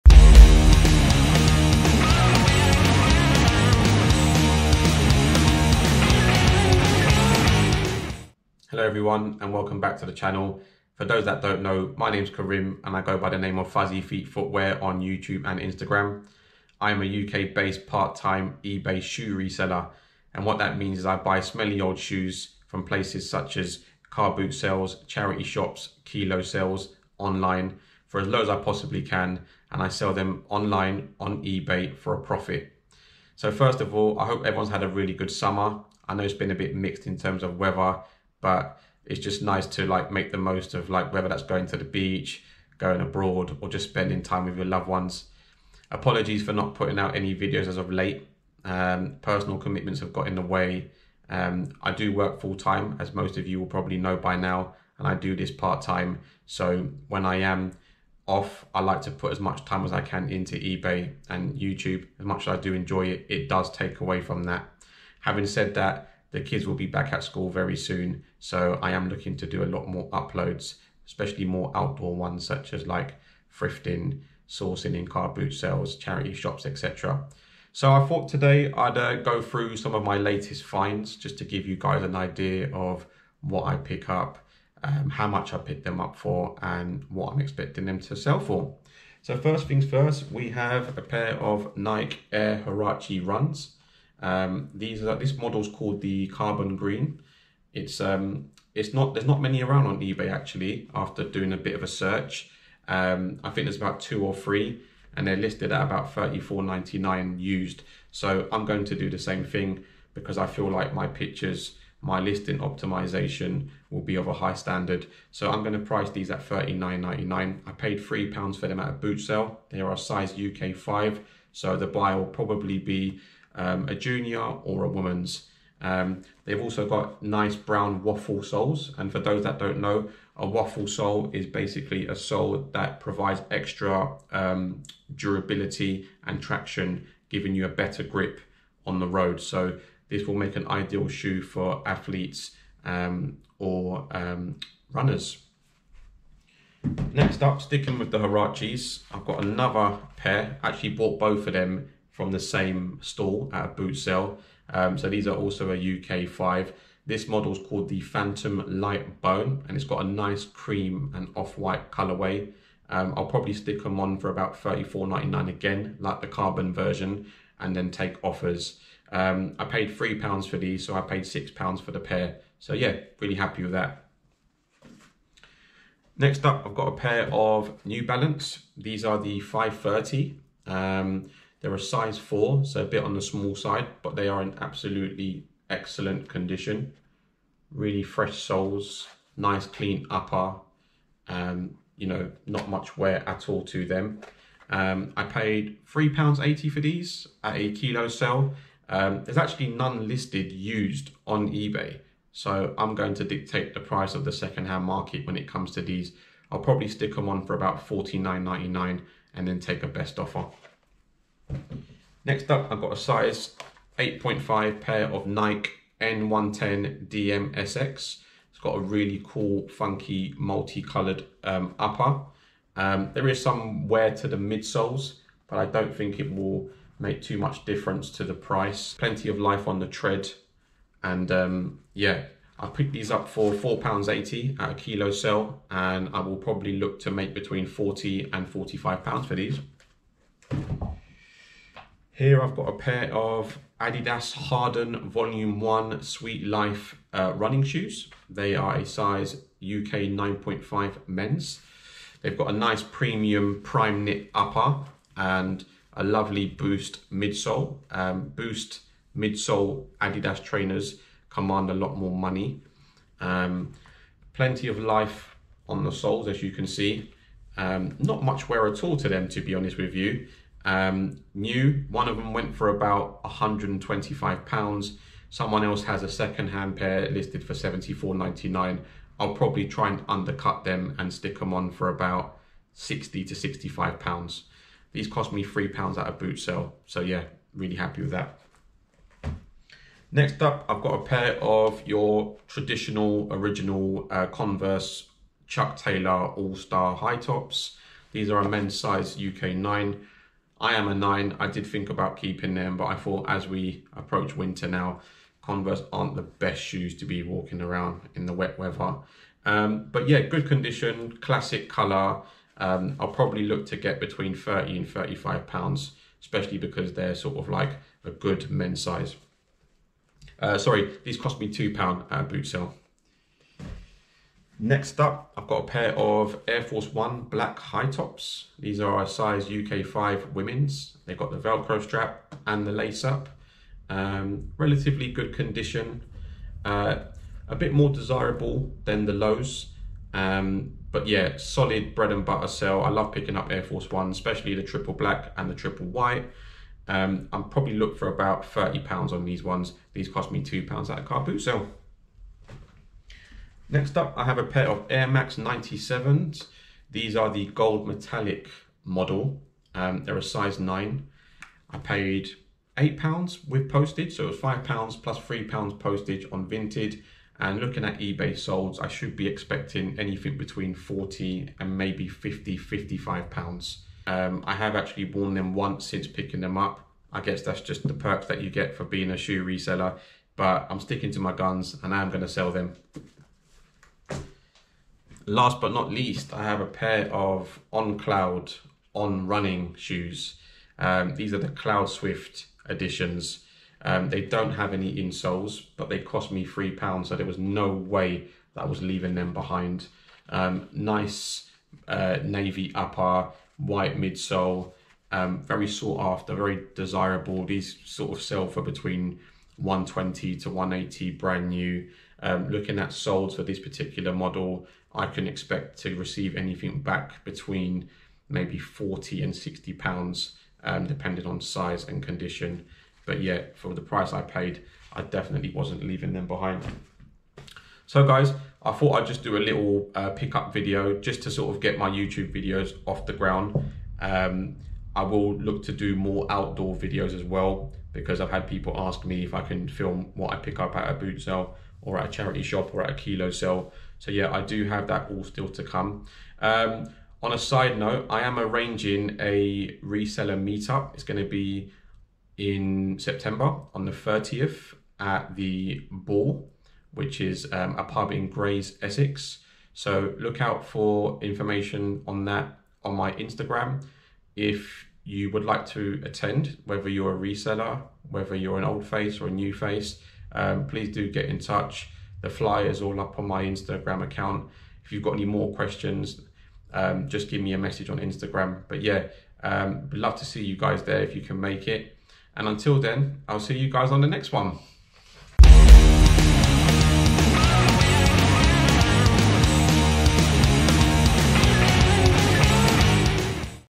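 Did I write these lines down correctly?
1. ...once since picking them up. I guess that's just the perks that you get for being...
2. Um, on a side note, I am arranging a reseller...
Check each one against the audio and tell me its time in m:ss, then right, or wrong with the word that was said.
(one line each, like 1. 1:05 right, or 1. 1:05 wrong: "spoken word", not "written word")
1. 6:15 right
2. 7:26 right.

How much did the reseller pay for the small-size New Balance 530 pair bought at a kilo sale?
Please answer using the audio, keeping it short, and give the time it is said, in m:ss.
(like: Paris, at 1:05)
£3.80, at 3:15.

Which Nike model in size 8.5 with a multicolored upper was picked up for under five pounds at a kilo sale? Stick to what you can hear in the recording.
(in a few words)
N110 DMSX.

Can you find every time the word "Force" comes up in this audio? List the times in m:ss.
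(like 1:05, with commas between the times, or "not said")
5:26, 5:43.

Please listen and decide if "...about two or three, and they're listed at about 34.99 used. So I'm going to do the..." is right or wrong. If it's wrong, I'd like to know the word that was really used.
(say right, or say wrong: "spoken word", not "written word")
right.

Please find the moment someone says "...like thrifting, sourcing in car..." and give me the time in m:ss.
1:12.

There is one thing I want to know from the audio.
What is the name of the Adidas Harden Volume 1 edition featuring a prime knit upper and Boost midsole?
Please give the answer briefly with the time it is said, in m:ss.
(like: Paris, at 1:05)
Sweet Life, at 4:06.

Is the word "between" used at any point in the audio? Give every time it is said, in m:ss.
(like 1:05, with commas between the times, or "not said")
3:57, 5:13, 6:10, 6:48, 6:57.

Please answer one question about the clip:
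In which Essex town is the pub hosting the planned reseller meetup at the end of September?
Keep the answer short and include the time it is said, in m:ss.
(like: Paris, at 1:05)
Grays, at 7:38.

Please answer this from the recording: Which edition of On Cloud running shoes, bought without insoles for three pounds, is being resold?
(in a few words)
Cloud Swift.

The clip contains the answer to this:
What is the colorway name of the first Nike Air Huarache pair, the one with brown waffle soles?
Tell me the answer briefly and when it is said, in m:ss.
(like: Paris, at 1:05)
Carbon Green, at 1:36.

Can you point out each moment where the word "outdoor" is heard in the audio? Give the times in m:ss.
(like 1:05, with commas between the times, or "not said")
1:11, 7:16.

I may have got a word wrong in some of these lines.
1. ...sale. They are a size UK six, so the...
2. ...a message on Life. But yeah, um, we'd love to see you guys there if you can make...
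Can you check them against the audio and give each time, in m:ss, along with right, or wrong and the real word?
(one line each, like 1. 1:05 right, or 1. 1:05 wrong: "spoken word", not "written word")
1. 1:59 wrong: "five", not "six"
2. 7:57 wrong: "Instagram", not "Life".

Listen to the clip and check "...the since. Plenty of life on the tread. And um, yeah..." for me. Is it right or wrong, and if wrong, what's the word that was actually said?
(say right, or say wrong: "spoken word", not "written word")
wrong: "price", not "since".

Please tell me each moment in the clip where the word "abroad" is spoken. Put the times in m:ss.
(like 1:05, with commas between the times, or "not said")
0:43.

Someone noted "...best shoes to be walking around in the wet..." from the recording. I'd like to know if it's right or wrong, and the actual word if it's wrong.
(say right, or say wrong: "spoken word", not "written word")
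right.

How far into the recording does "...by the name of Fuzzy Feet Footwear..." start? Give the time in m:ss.
0:13.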